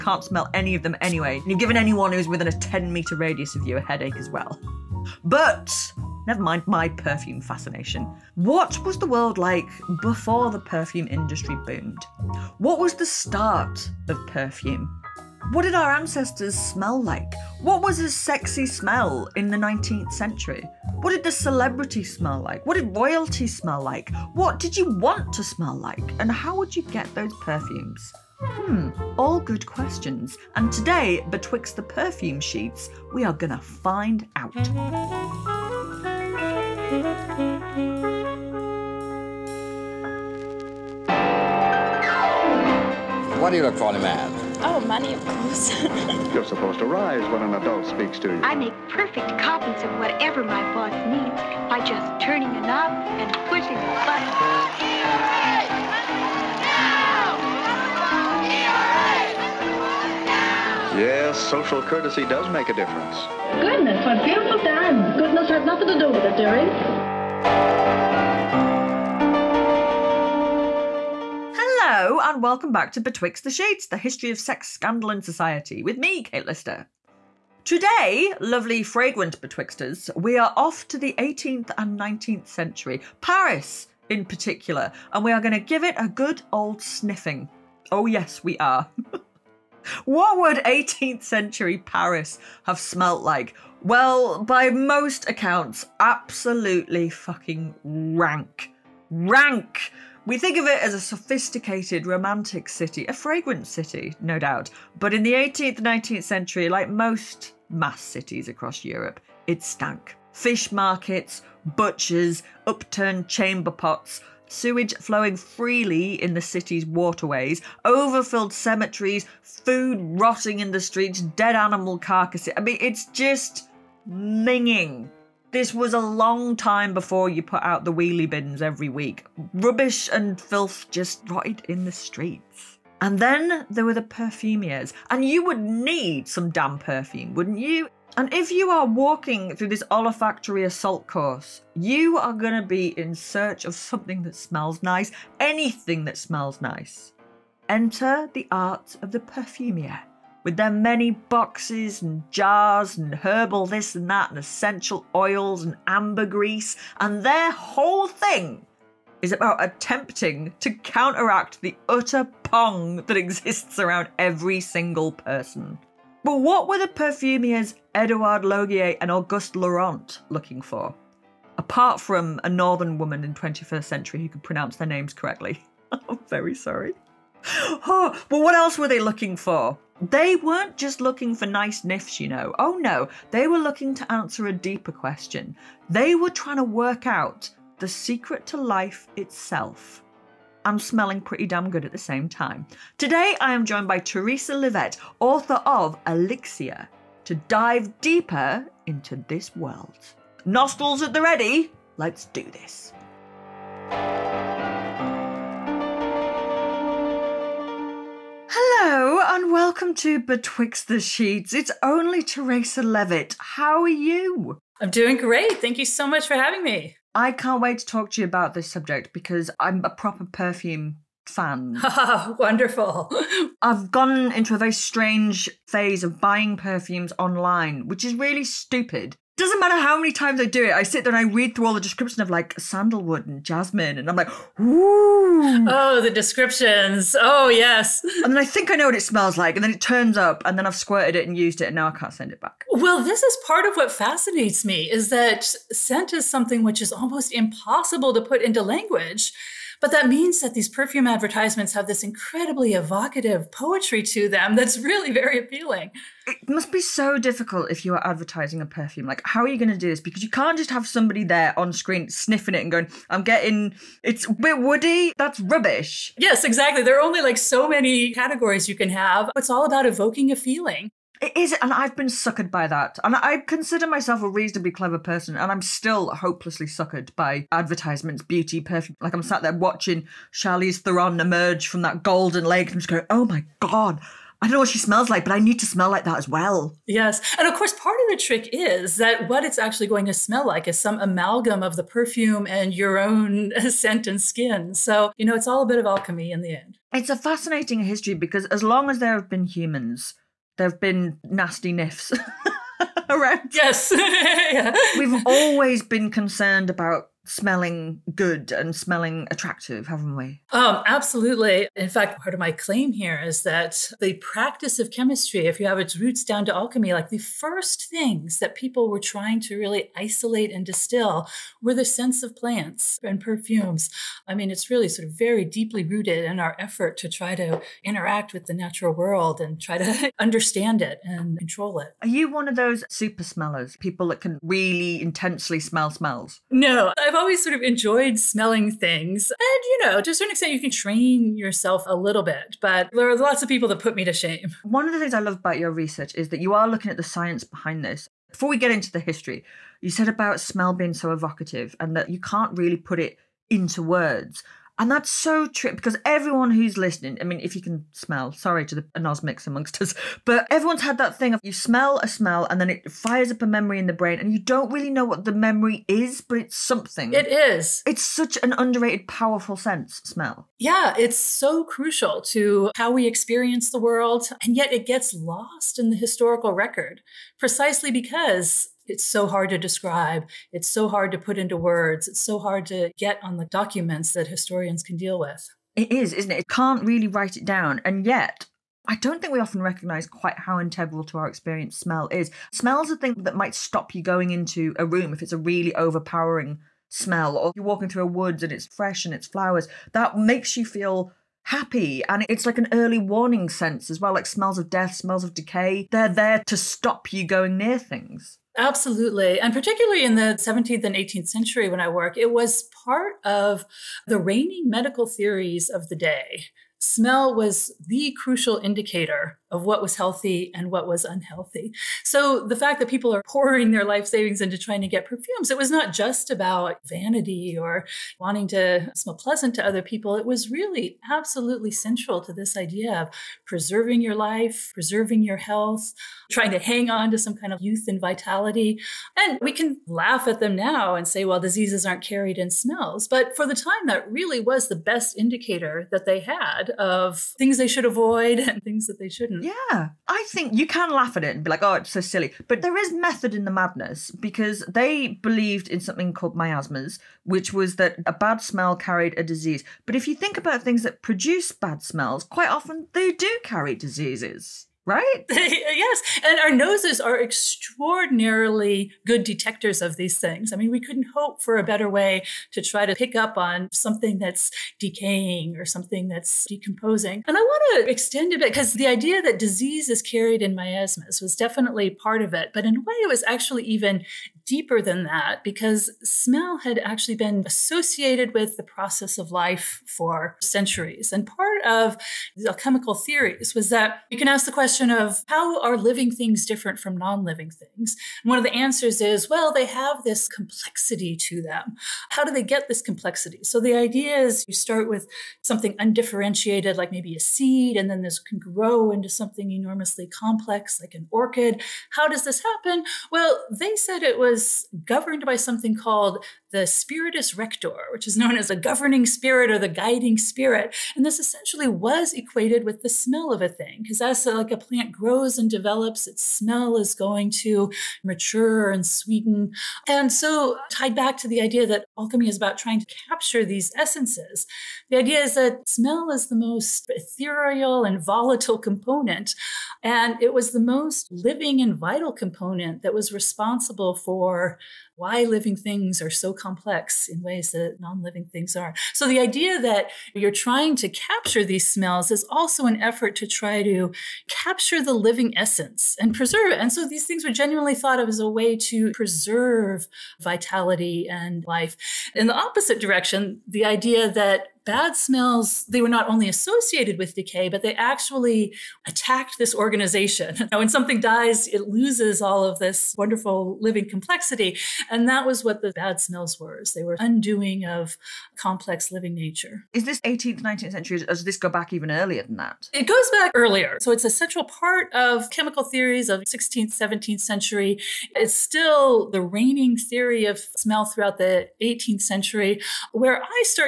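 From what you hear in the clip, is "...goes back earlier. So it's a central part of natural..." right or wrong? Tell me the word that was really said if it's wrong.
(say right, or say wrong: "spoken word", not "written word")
wrong: "chemical", not "natural".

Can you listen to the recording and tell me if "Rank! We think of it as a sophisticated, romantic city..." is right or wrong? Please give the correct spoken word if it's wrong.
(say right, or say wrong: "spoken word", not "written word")
right.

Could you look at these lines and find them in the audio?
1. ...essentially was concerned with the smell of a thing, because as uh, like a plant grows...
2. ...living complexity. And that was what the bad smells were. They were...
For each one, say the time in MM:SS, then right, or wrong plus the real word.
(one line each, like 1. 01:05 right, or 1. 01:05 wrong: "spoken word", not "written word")
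1. 08:41 wrong: "equated", not "concerned"
2. 09:33 right.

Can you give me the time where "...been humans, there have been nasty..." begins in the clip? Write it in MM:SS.
04:59.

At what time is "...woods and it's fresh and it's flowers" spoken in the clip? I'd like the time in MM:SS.
06:38.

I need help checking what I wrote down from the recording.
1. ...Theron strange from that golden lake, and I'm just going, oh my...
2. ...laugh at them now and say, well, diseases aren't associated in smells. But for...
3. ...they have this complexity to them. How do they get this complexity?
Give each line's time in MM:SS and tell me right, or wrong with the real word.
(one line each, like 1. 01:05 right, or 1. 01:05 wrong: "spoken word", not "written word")
1. 04:40 wrong: "emerge", not "strange"
2. 07:19 wrong: "carried", not "associated"
3. 08:19 right.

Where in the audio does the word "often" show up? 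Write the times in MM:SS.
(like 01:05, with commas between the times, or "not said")
06:29, 07:42.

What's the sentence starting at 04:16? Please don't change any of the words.
It must be so difficult if you are advertising a perfume.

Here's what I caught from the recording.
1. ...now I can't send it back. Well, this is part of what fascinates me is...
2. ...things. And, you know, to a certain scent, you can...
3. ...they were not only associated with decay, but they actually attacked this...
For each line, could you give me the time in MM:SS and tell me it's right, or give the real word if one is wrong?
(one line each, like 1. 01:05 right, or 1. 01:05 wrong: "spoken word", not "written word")
1. 04:01 right
2. 05:38 wrong: "extent", not "scent"
3. 09:25 right.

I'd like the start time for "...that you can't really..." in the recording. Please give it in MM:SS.
05:51.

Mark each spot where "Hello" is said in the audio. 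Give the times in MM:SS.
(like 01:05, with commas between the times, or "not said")
01:11.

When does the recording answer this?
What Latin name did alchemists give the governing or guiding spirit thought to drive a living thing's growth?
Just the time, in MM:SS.
08:36.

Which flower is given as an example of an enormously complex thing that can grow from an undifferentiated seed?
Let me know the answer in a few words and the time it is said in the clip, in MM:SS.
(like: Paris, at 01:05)
orchid, at 08:31.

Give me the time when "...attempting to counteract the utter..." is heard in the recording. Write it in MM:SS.
02:39.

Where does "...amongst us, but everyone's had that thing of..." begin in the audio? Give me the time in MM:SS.
05:59.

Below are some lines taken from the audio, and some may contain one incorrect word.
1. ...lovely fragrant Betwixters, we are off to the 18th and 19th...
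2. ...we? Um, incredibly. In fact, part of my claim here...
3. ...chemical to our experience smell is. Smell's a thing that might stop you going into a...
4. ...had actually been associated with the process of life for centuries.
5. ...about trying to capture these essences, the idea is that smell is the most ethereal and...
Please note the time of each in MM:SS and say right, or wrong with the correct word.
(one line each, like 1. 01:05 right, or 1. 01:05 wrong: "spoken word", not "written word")
1. 01:18 right
2. 05:10 wrong: "absolutely", not "incredibly"
3. 06:30 wrong: "integral", not "chemical"
4. 08:06 right
5. 08:52 right.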